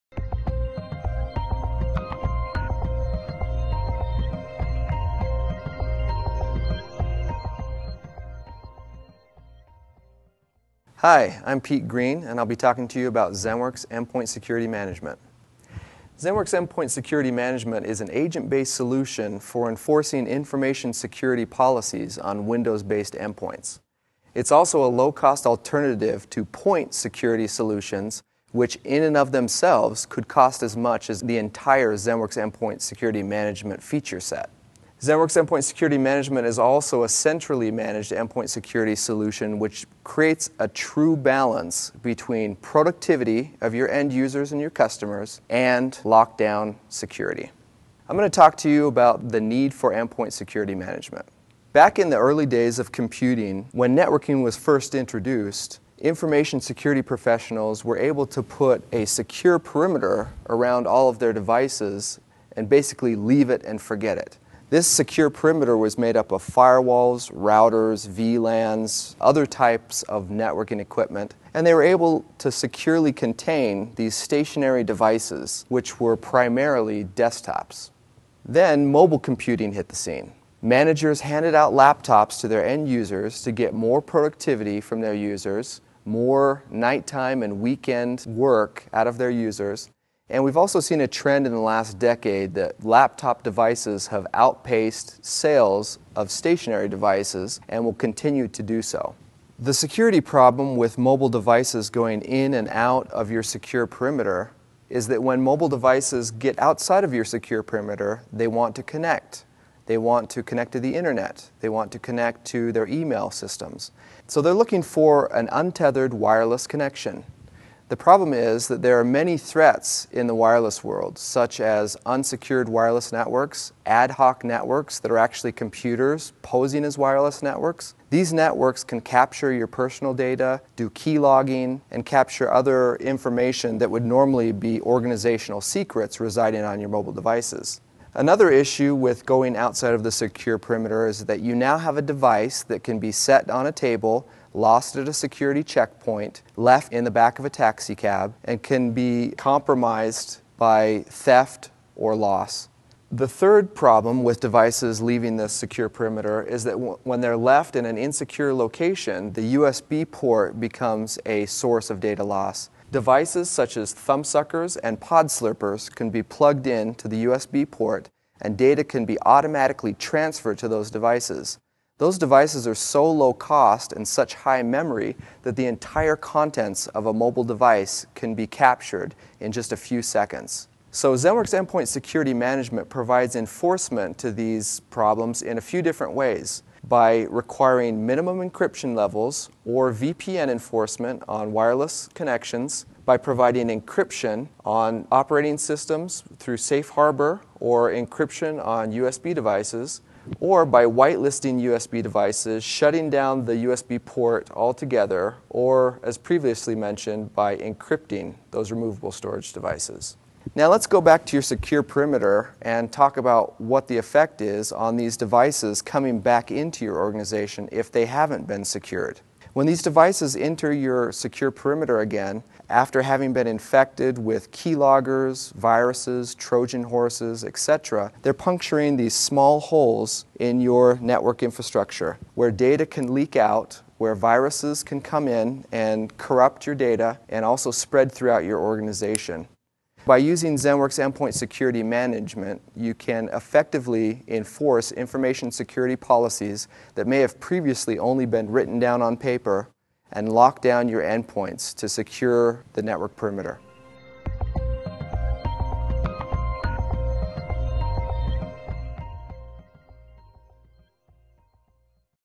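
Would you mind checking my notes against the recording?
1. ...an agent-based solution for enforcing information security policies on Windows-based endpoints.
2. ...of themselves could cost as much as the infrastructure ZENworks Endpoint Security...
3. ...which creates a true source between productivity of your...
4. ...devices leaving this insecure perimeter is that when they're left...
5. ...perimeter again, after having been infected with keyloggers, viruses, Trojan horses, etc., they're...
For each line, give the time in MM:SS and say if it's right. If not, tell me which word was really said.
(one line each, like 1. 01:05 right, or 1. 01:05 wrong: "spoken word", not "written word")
1. 00:18 right
2. 00:29 wrong: "entire", not "infrastructure"
3. 00:39 wrong: "balance", not "source"
4. 02:34 wrong: "secure", not "insecure"
5. 03:41 right.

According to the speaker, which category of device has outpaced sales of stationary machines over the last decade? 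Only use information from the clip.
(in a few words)
laptop devices.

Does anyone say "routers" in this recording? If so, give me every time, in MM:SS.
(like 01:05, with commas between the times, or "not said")
01:07.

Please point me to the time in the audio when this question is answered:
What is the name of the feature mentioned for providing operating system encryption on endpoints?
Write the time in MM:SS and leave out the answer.
03:16.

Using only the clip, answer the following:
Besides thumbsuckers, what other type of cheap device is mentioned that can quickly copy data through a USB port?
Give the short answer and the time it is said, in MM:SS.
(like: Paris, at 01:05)
pod slurpers, at 02:44.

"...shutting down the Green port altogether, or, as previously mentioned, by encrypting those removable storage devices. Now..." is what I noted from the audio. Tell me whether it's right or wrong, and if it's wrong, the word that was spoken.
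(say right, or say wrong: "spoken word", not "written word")
wrong: "USB", not "Green".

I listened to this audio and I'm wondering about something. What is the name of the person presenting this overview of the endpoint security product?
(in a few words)
Pete Green.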